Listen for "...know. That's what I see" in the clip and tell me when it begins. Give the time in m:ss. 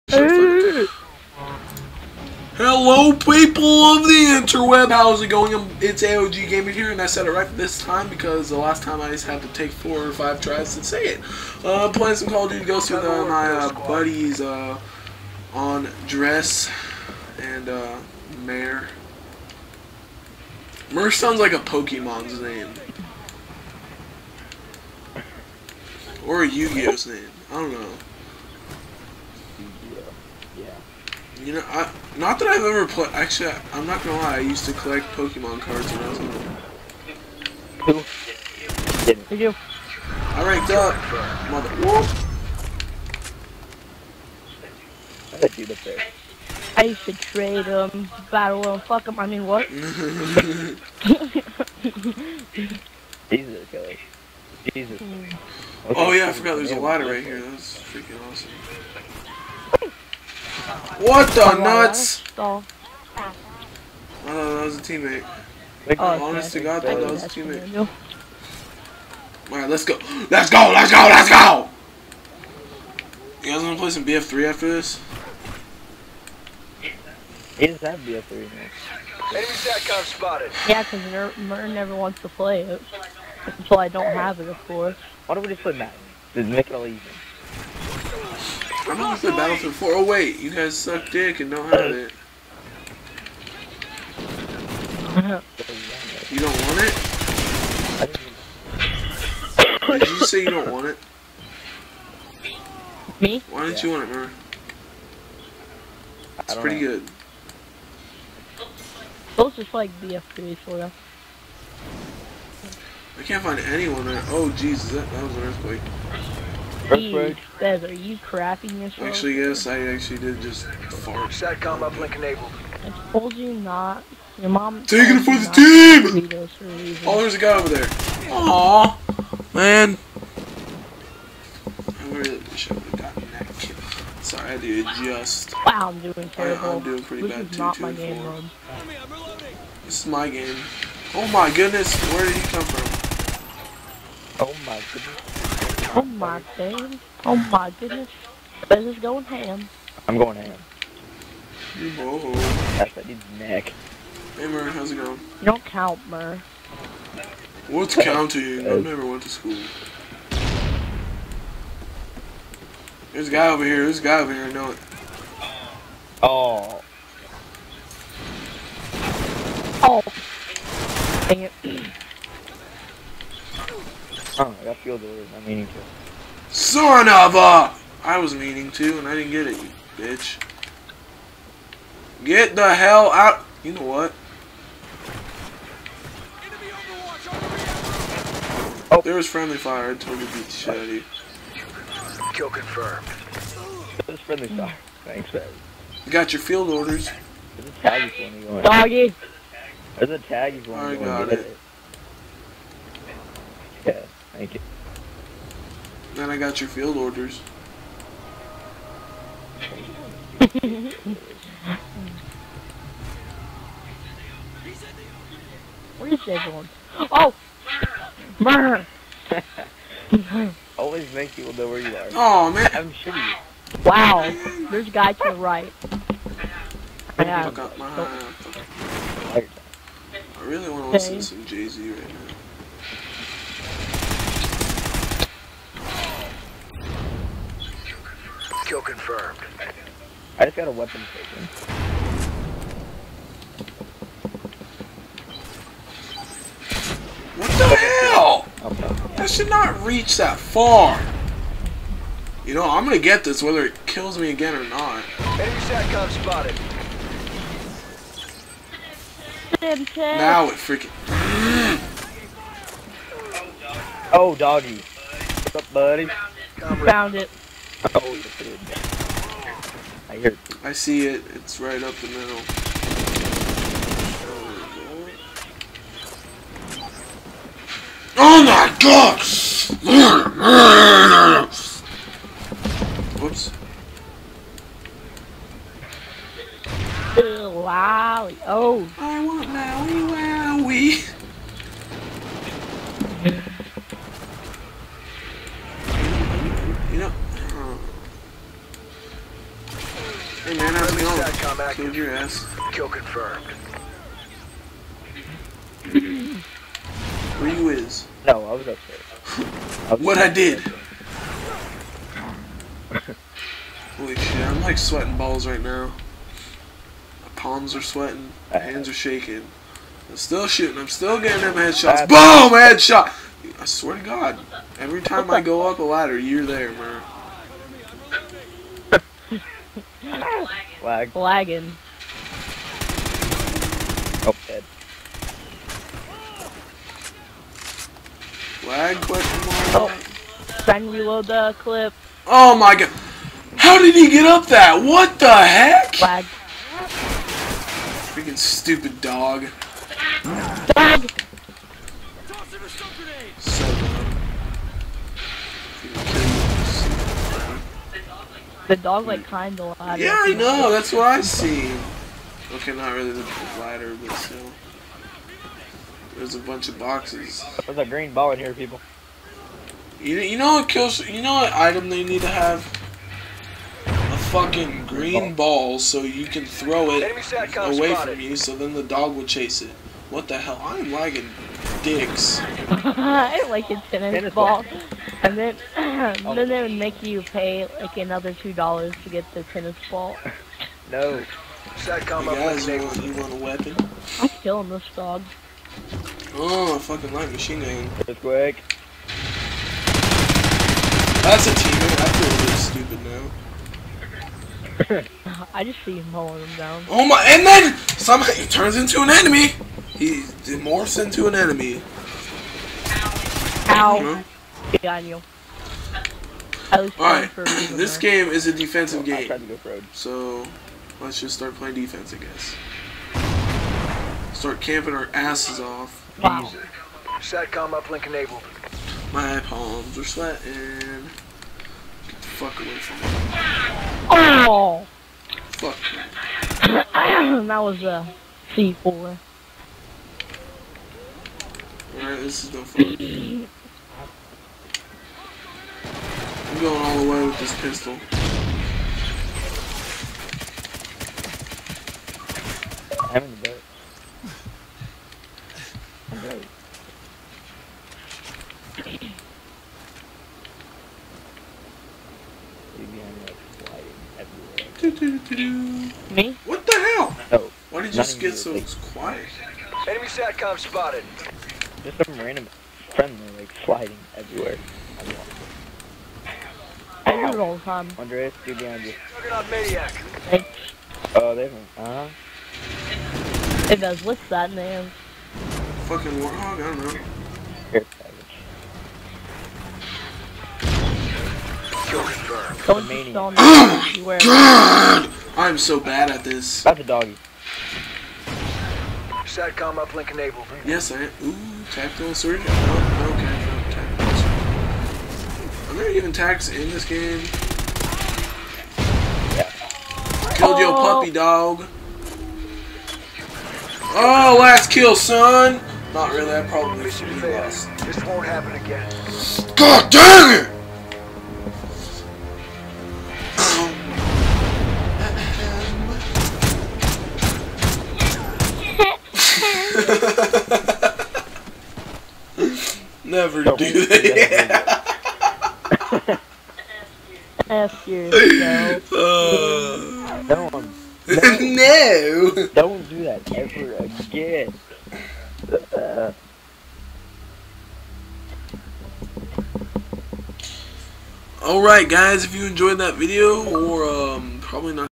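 6:00.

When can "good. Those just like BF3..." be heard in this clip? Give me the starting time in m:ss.
1:46.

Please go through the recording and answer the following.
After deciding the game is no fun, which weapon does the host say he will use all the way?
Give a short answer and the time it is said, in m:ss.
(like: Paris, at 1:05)
pistol, at 7:27.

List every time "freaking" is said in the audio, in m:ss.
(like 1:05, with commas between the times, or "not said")
4:20, 5:48.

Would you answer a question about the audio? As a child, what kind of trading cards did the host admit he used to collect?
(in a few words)
Pokemon cards.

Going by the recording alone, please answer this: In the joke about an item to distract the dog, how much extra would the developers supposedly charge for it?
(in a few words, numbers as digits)
2 dollars.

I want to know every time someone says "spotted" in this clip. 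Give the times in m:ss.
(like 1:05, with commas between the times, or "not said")
1:20, 4:16, 7:50.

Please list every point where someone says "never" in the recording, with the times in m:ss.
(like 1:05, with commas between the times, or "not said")
1:21, 2:38.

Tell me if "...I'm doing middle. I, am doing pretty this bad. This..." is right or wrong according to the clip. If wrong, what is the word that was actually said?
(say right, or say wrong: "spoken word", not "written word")
wrong: "terrible", not "middle".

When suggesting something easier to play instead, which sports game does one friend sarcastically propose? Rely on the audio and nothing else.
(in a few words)
Madden.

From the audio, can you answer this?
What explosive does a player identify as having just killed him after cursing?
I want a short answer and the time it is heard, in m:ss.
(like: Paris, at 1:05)
C4, at 7:18.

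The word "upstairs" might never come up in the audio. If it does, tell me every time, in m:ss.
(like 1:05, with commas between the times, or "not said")
5:08.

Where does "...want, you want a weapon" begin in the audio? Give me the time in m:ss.
6:32.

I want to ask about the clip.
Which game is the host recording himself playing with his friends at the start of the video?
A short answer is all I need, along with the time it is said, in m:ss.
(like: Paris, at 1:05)
Call of Duty Ghosts, at 0:12.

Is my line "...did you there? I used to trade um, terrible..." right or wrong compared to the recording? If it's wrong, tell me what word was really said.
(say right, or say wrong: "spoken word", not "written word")
wrong: "battle", not "terrible".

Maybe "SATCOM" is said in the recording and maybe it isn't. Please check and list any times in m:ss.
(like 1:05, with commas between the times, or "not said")
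1:19, 2:01, 4:15, 7:07, 7:50, 8:19.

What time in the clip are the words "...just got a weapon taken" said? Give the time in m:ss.
4:00.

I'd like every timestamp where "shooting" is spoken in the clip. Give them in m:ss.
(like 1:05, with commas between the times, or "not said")
3:42, 5:20.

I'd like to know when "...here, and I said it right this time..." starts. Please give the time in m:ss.
0:06.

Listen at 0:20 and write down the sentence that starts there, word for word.
Murr sounds like a Pokemon's name.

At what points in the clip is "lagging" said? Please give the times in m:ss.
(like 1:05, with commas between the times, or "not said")
5:31, 6:20.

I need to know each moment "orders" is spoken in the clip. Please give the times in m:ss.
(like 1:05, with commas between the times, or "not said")
2:55, 3:16, 3:26.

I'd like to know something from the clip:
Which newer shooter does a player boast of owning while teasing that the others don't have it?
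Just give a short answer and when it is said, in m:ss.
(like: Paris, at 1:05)
Battlefield 4, at 1:29.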